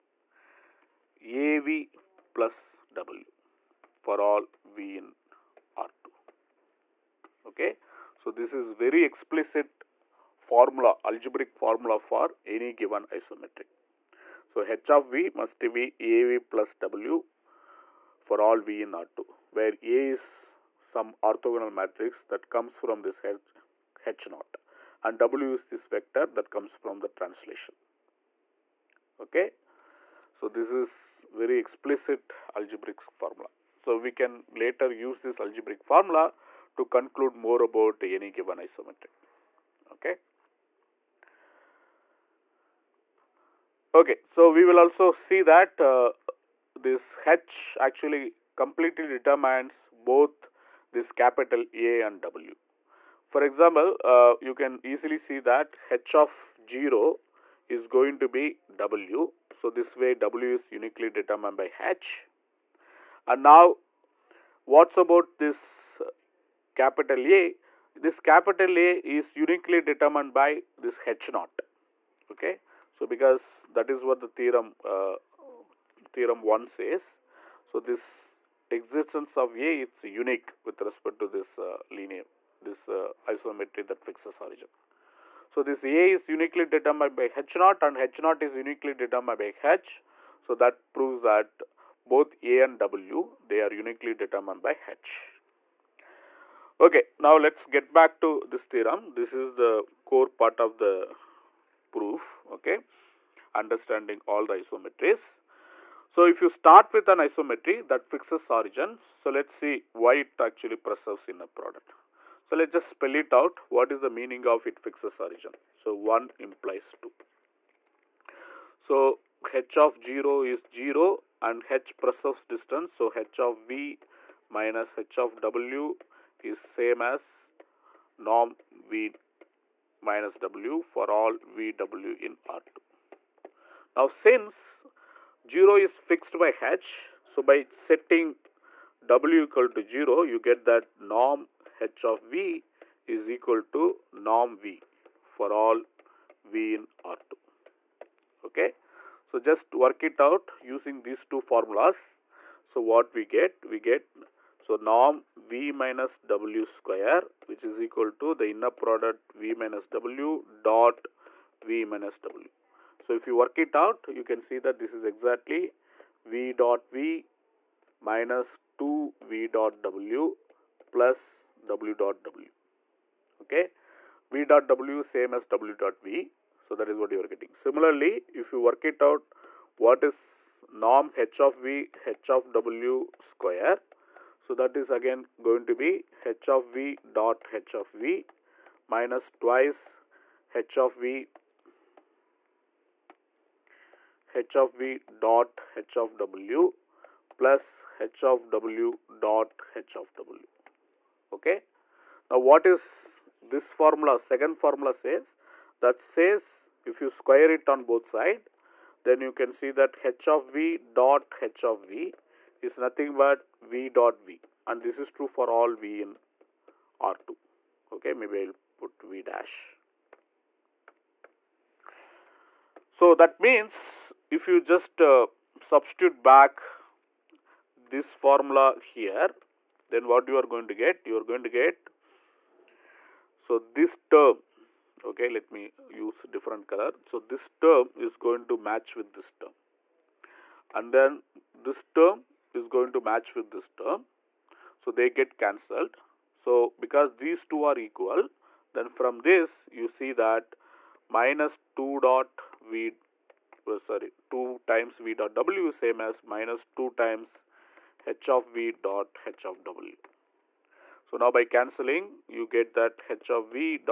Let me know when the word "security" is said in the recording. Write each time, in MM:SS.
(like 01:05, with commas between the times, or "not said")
not said.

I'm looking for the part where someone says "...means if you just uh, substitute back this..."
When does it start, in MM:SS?
03:43.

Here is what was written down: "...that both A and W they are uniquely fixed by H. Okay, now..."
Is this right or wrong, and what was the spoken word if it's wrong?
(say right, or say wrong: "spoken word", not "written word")
wrong: "determined", not "fixed".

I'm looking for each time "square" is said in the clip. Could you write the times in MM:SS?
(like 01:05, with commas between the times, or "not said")
02:36, 03:03, 03:27.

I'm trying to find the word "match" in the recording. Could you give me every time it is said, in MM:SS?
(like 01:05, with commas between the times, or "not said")
03:58, 04:02.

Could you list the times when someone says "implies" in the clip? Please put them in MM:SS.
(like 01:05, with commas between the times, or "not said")
01:56.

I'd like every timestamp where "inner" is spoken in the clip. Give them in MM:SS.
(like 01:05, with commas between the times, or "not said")
01:51, 02:38.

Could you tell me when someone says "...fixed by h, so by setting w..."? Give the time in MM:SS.
02:15.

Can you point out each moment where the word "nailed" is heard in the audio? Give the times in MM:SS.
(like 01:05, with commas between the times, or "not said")
not said.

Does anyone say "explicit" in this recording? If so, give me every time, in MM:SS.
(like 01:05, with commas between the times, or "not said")
00:09, 00:31.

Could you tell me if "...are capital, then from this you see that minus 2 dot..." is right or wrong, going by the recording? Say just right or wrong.
wrong.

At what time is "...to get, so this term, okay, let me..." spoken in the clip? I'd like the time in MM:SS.
03:51.